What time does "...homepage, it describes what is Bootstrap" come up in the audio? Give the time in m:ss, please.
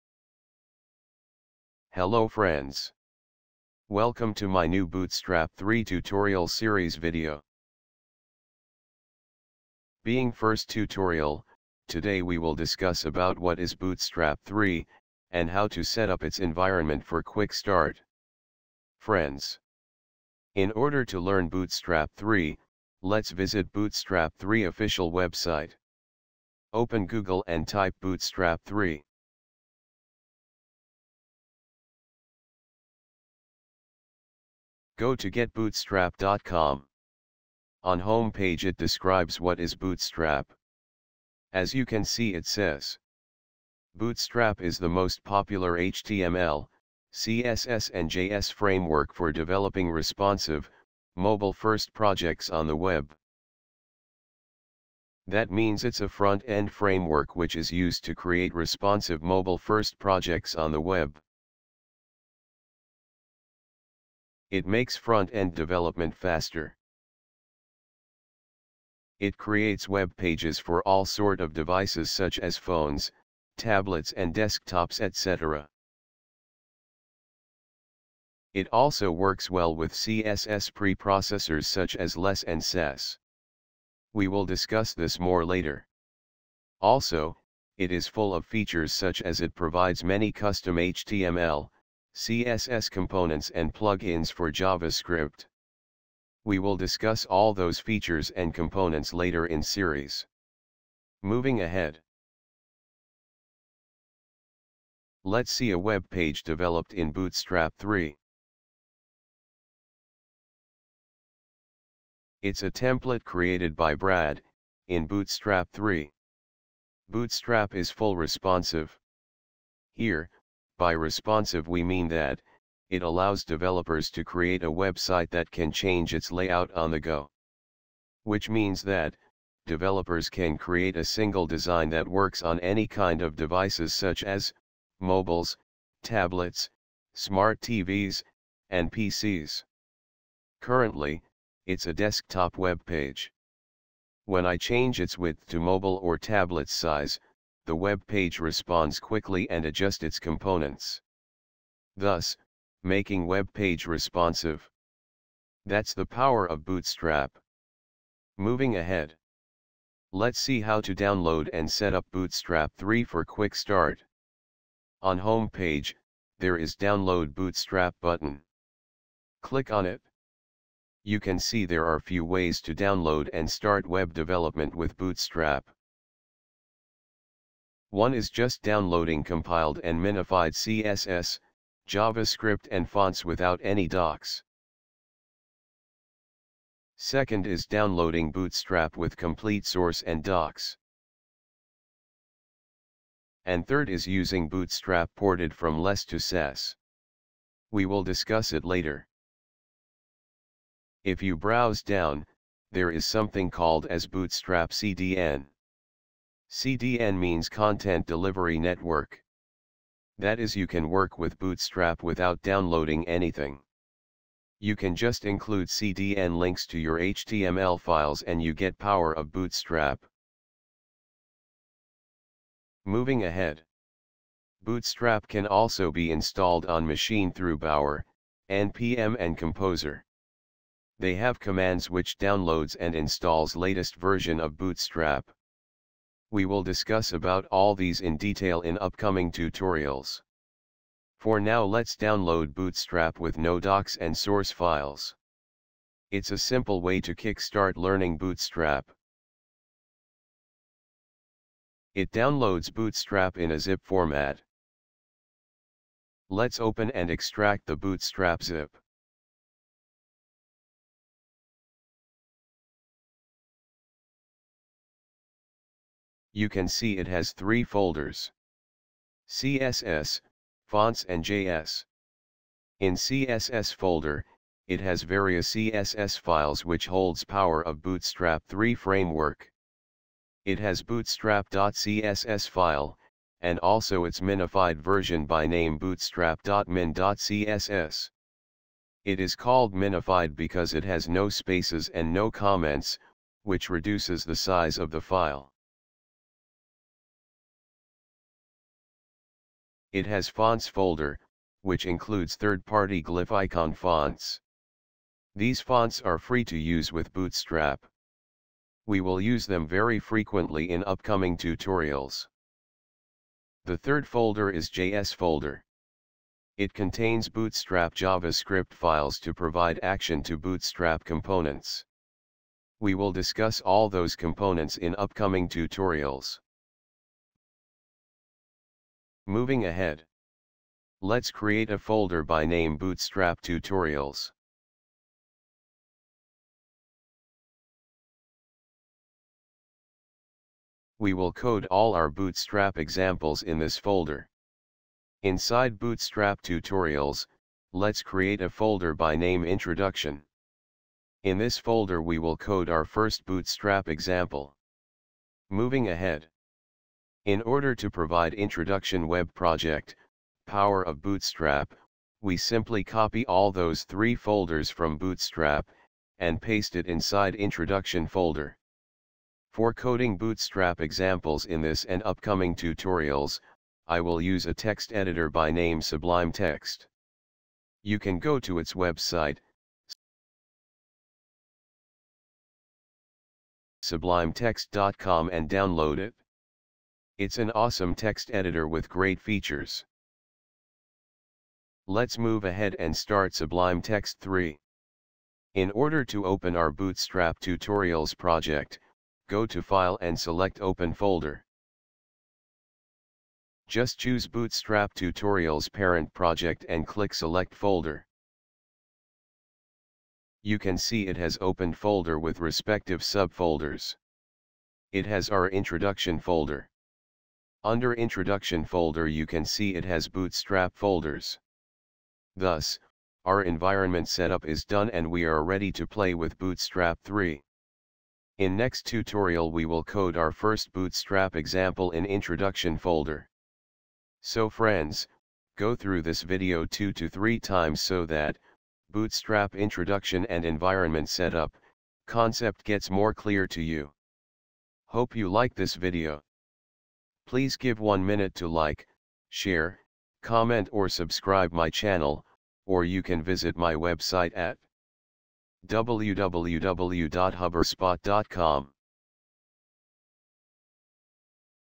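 0:38.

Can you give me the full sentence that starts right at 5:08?
We will use them very frequently in upcoming tutorials.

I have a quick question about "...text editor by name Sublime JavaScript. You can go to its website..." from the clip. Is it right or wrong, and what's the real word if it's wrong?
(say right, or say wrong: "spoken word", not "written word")
wrong: "Text", not "JavaScript".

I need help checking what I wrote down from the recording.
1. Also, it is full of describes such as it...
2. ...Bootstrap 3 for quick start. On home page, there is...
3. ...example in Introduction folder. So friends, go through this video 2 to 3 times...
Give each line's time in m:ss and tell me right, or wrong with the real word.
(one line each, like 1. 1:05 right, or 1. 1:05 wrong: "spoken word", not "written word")
1. 1:26 wrong: "features", not "describes"
2. 2:42 right
3. 7:11 right.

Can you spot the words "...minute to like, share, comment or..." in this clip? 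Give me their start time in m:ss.
7:28.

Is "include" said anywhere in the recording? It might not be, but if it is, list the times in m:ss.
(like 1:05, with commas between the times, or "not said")
3:35, 5:01.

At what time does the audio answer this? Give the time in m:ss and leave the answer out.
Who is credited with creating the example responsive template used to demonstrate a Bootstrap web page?
1:53.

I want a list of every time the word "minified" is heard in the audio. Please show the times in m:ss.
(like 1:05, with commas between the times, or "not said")
2:59, 4:44, 4:49.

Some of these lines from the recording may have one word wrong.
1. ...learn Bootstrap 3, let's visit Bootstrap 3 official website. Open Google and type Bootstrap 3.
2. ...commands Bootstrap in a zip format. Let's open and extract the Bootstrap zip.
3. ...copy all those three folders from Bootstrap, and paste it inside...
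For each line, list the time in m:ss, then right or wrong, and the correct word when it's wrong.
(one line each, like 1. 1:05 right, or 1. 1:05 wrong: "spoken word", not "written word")
1. 0:21 right
2. 4:12 wrong: "downloads", not "commands"
3. 6:02 right.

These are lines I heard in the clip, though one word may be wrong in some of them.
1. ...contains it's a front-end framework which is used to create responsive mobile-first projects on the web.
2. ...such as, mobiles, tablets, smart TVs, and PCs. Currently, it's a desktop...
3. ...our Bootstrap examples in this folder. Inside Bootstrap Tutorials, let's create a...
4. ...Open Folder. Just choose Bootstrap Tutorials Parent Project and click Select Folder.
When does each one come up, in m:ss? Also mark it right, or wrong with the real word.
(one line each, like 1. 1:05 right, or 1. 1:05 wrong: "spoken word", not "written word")
1. 0:55 wrong: "means", not "contains"
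2. 2:13 right
3. 5:41 right
4. 6:40 right.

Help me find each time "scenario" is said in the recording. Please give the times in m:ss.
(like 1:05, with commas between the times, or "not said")
not said.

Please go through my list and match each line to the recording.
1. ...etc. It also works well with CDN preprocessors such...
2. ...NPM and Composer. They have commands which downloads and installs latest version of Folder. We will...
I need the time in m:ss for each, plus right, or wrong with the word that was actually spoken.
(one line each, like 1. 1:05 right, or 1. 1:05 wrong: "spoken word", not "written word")
1. 1:14 wrong: "CSS", not "CDN"
2. 3:48 wrong: "Bootstrap", not "Folder".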